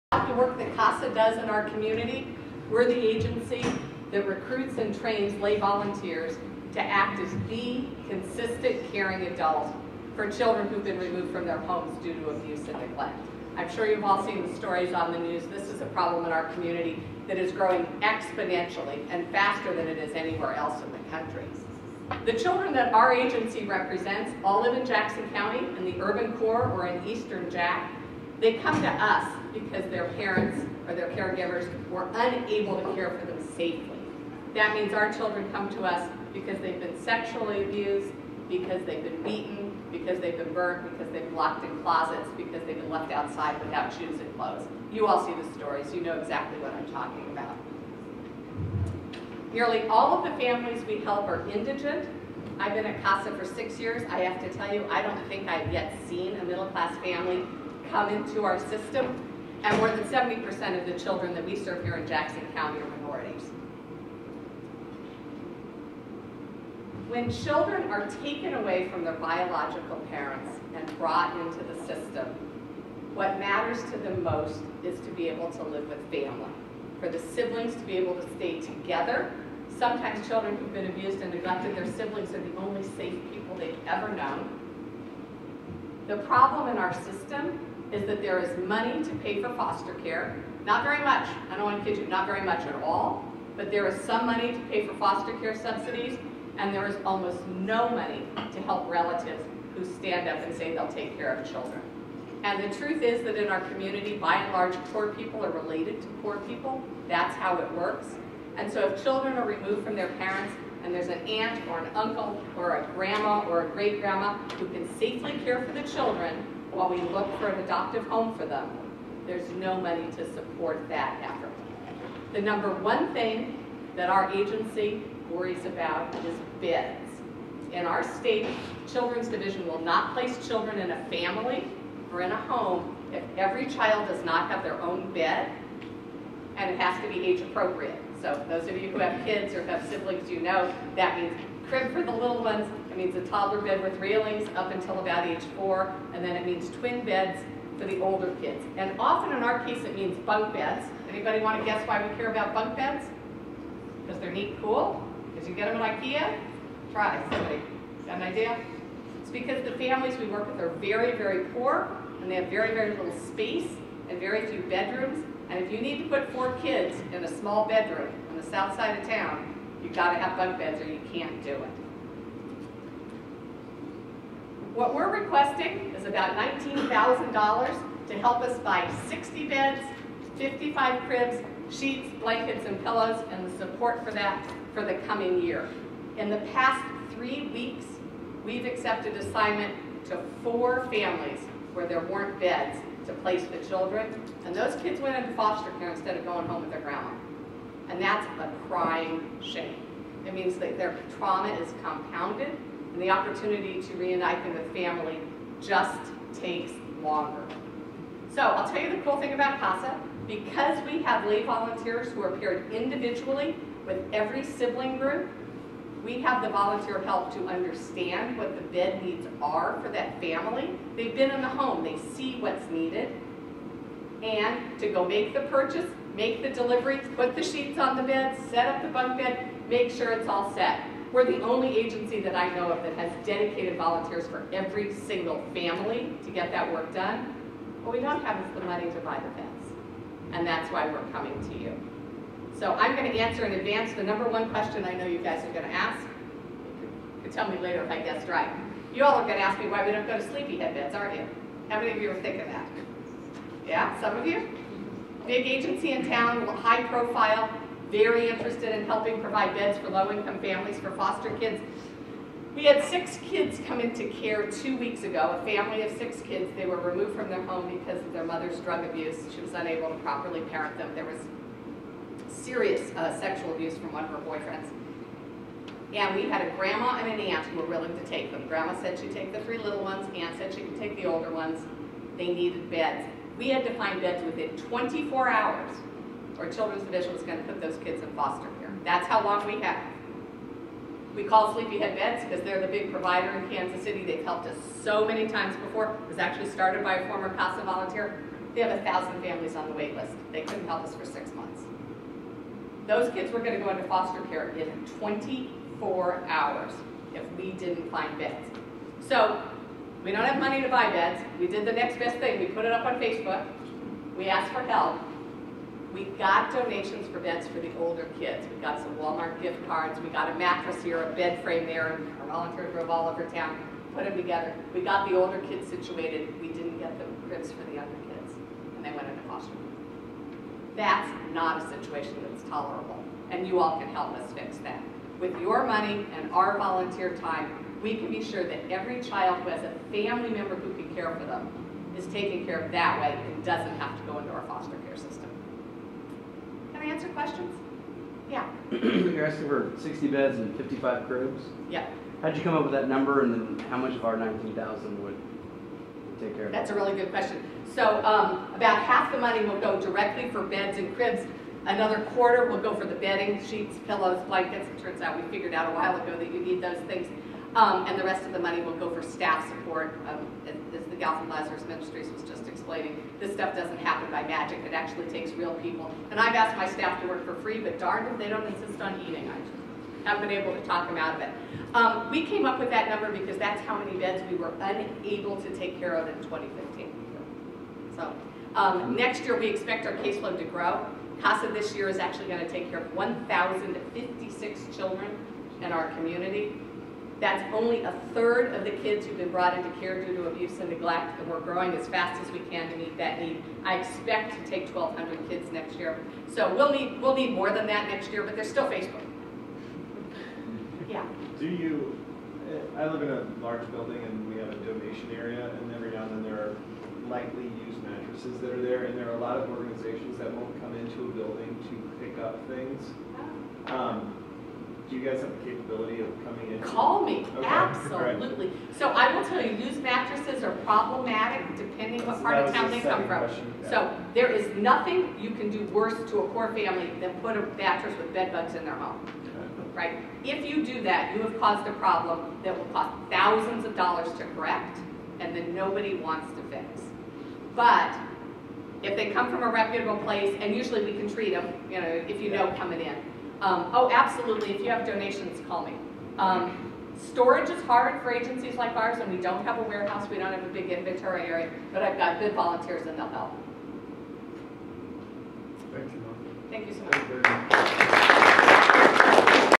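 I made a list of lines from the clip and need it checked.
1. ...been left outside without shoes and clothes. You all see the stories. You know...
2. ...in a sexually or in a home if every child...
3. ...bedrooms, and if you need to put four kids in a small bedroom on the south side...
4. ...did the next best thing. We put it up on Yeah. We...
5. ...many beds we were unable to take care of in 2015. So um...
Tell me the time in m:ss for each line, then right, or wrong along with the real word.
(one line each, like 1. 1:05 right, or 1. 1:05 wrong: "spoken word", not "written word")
1. 0:42 right
2. 2:10 wrong: "family", not "sexually"
3. 2:44 right
4. 5:11 wrong: "Facebook", not "Yeah"
5. 6:23 right.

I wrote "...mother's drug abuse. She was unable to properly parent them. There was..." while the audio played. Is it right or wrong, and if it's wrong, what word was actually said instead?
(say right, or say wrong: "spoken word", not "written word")
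right.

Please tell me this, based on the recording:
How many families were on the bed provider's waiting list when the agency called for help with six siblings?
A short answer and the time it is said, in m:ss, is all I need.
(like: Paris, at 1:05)
1,000, at 4:58.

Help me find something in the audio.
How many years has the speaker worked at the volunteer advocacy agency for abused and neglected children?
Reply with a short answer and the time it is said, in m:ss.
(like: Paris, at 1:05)
6 years, at 0:53.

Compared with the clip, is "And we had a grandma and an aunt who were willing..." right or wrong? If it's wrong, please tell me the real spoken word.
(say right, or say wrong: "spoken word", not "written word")
right.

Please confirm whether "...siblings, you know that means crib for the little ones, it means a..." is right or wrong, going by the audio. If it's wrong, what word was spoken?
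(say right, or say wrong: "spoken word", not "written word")
right.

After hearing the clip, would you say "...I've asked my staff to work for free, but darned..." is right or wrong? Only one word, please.
right.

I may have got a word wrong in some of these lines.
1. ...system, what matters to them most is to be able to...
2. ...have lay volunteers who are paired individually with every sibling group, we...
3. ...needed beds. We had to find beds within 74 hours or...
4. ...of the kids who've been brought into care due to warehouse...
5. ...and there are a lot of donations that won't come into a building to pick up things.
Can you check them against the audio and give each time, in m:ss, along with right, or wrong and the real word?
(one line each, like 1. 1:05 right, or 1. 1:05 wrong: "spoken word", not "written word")
1. 1:11 right
2. 3:31 right
3. 4:42 wrong: "24", not "74"
4. 6:38 wrong: "abuse", not "warehouse"
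5. 6:58 wrong: "organizations", not "donations".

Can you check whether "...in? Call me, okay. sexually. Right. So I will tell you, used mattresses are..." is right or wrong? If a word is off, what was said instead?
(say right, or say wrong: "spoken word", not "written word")
wrong: "absolutely", not "sexually".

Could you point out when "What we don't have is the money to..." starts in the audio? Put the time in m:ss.
3:57.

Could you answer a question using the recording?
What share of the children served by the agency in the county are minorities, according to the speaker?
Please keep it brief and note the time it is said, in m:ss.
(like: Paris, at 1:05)
more than 70%, at 0:59.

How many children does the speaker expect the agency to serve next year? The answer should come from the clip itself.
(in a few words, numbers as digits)
1,200.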